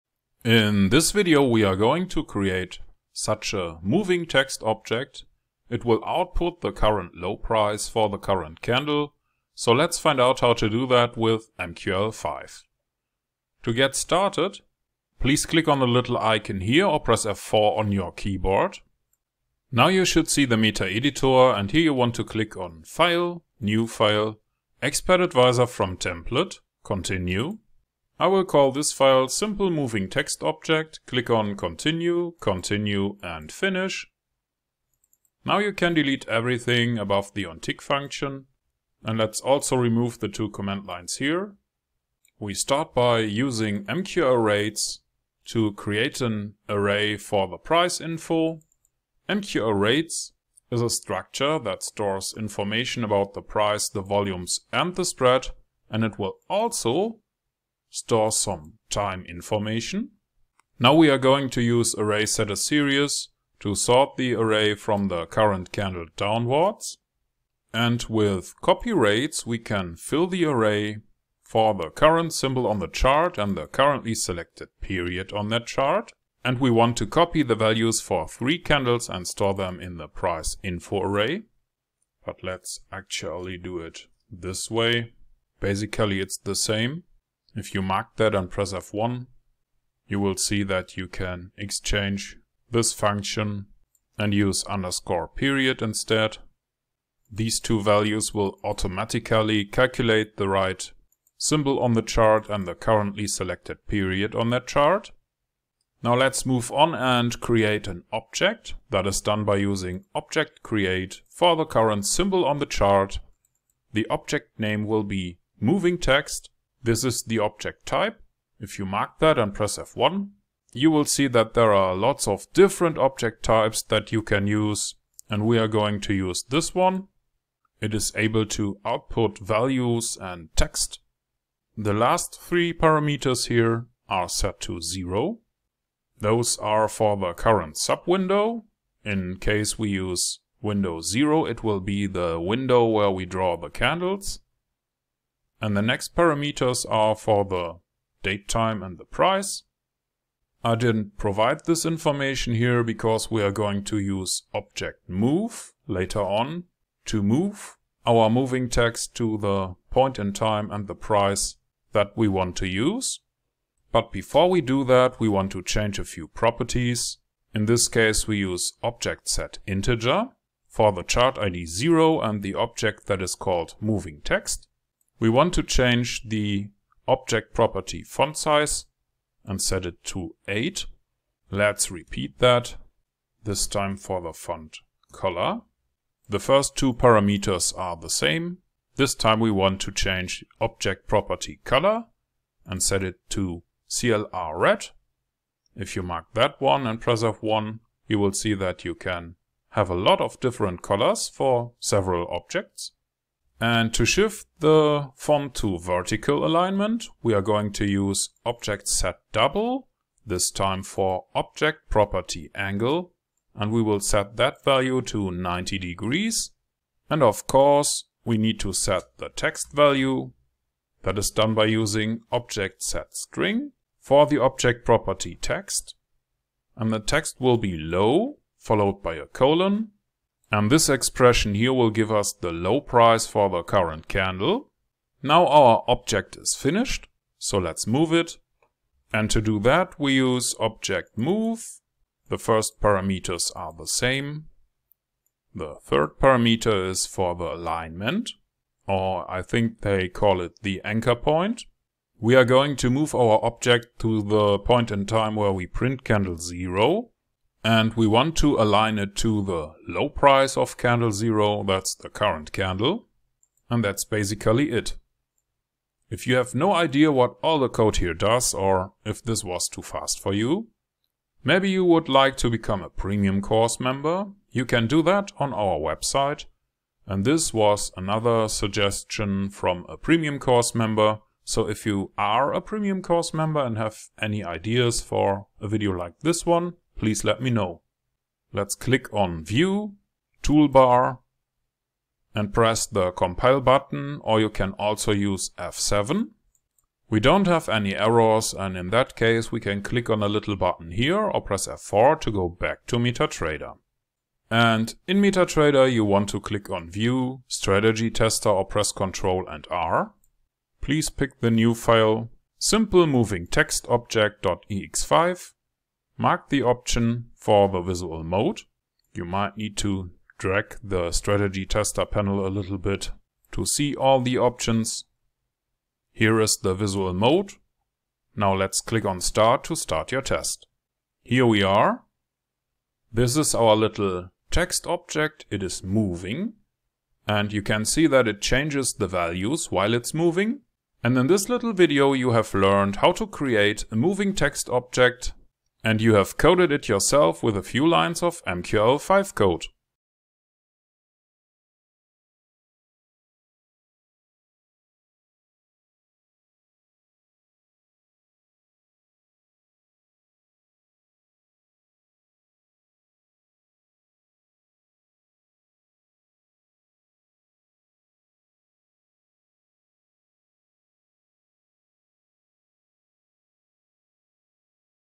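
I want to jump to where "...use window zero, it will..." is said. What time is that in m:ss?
2:19.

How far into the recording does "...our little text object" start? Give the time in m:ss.
5:33.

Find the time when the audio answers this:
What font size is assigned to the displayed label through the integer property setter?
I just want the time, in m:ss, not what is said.
3:00.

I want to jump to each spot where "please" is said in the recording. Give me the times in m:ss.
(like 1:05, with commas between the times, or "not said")
0:15, 4:47, 5:10.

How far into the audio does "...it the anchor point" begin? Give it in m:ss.
4:10.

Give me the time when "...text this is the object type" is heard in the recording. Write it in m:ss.
1:55.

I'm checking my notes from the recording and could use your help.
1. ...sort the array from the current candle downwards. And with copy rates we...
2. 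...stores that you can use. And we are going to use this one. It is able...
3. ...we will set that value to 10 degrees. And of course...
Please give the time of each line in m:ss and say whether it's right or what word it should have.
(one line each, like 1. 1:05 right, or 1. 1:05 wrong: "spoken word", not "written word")
1. 1:03 right
2. 2:03 wrong: "types", not "stores"
3. 3:33 wrong: "90", not "10".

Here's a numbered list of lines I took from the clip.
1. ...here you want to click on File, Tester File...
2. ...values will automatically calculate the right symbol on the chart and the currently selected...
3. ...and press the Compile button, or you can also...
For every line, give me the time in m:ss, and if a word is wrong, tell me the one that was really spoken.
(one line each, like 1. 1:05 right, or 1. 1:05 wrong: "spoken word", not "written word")
1. 0:21 wrong: "New", not "Tester"
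2. 1:37 right
3. 4:52 right.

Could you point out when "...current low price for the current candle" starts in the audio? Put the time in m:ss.
0:06.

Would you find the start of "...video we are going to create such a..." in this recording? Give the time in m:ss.
0:01.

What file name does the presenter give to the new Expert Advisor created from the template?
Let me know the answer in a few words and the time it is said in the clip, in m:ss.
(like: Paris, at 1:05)
simple moving text object, at 0:29.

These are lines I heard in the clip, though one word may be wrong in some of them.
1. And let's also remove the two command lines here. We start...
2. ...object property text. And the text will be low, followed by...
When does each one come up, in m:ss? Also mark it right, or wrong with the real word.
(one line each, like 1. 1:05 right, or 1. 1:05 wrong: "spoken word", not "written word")
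1. 0:39 right
2. 3:44 right.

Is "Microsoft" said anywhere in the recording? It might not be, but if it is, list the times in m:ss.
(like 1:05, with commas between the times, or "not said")
not said.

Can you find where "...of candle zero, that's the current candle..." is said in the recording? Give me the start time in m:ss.
4:20.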